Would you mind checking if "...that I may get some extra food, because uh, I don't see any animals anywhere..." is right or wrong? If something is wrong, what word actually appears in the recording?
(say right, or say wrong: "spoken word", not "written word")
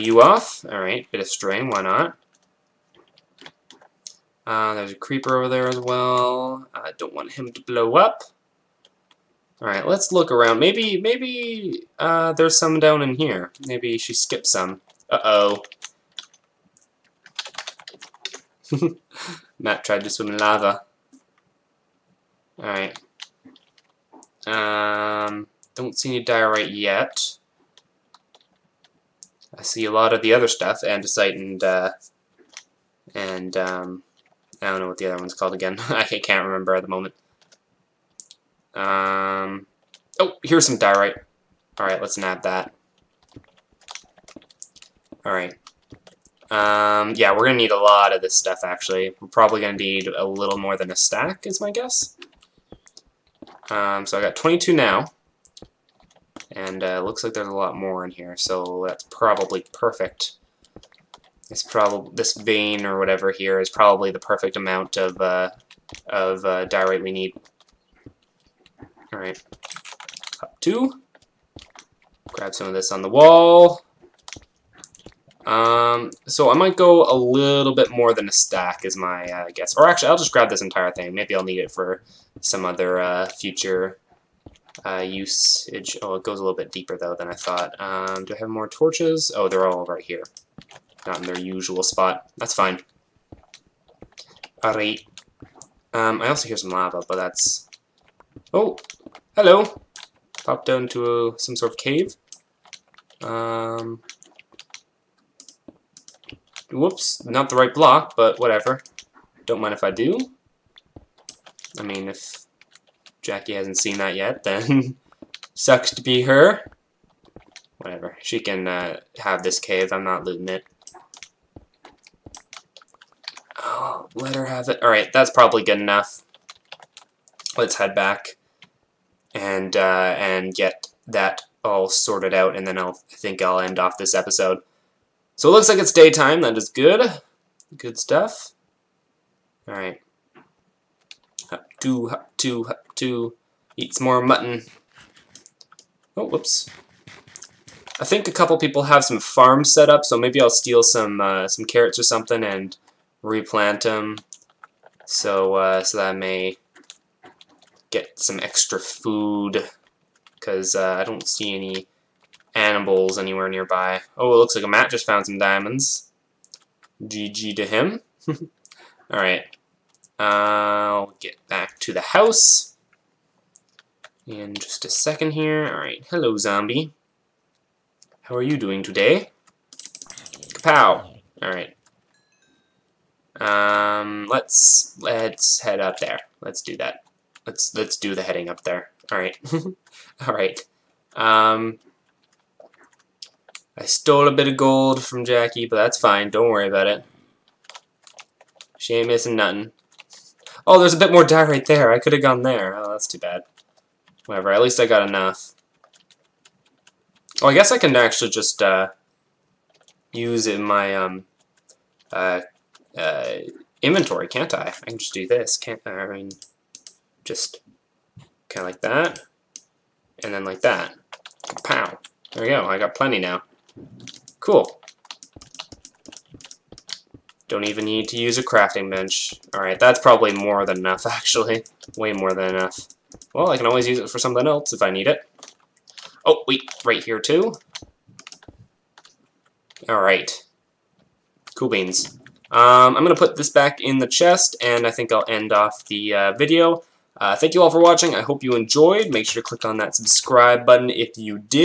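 right.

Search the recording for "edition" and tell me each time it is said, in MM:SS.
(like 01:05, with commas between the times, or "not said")
not said.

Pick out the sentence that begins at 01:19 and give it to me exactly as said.
Or actually, I'll just grab this entire thing.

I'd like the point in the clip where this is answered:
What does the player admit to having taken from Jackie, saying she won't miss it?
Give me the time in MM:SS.
03:14.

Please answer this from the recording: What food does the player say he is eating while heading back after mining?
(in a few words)
Mutton.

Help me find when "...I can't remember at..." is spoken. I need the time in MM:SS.
00:35.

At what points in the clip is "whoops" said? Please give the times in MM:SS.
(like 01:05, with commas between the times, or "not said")
01:46, 02:26.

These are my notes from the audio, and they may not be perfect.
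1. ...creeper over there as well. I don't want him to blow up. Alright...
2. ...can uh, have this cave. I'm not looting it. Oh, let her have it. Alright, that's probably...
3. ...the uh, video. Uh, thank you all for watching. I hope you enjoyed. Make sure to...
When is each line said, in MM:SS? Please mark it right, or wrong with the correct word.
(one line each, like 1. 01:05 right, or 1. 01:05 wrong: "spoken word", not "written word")
1. 00:04 right
2. 01:58 right
3. 04:05 right.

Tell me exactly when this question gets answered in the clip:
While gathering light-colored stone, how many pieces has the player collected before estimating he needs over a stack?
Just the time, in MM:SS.
00:54.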